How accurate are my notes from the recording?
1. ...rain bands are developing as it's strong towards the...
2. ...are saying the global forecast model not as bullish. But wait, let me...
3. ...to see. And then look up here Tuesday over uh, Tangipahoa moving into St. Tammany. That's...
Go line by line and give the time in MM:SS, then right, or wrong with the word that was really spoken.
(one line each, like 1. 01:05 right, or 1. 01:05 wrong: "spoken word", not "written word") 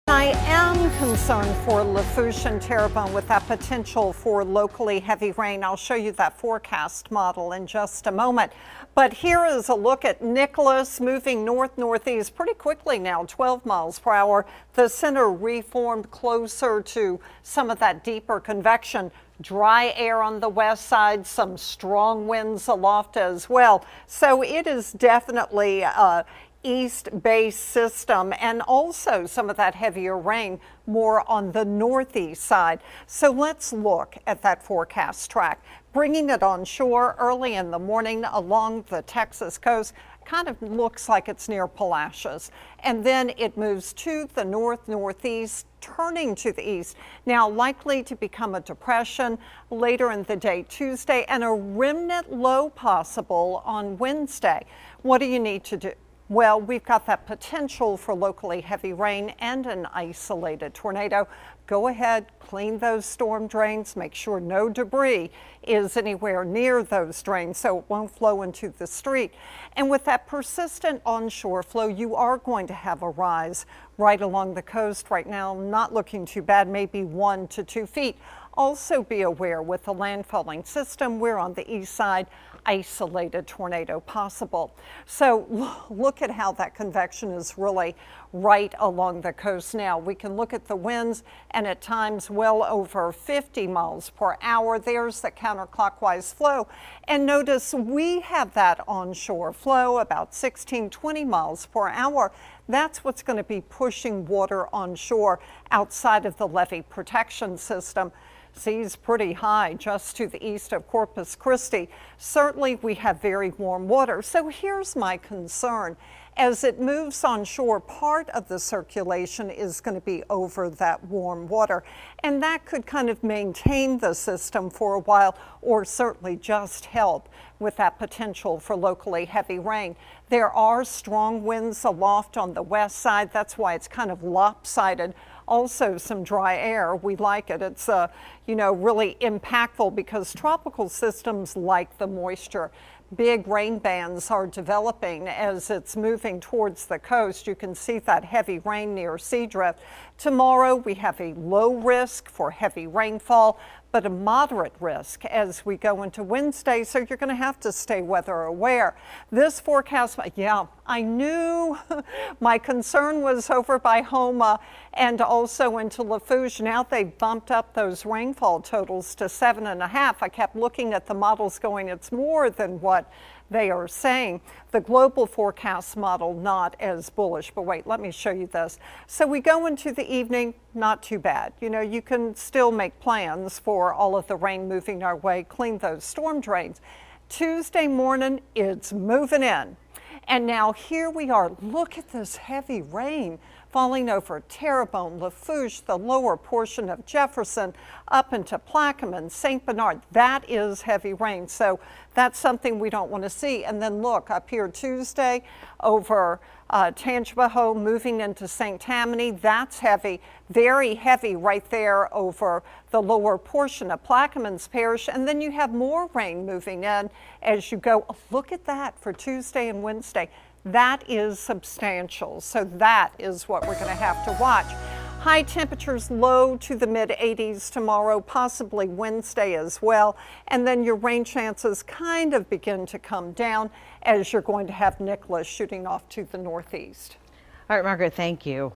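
1. 02:23 wrong: "moving", not "strong"
2. 02:53 right
3. 03:23 right.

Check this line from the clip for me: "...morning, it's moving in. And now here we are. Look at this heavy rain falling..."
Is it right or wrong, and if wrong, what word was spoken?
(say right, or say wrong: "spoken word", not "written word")
right.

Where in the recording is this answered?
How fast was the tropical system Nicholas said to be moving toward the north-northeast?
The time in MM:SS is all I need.
00:13.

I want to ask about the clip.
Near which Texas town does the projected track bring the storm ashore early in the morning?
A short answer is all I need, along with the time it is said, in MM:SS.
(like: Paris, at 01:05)
Palacios, at 00:41.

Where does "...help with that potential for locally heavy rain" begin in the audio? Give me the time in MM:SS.
02:06.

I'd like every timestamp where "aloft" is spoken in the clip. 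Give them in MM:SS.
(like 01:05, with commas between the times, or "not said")
00:22, 02:11.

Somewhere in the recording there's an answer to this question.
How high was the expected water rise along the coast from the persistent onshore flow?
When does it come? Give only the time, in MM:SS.
01:17.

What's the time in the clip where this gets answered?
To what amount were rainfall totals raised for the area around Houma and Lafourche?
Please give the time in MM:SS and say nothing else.
02:49.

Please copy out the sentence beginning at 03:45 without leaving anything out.
High temperatures low to the mid 80s tomorrow, possibly Wednesday as well.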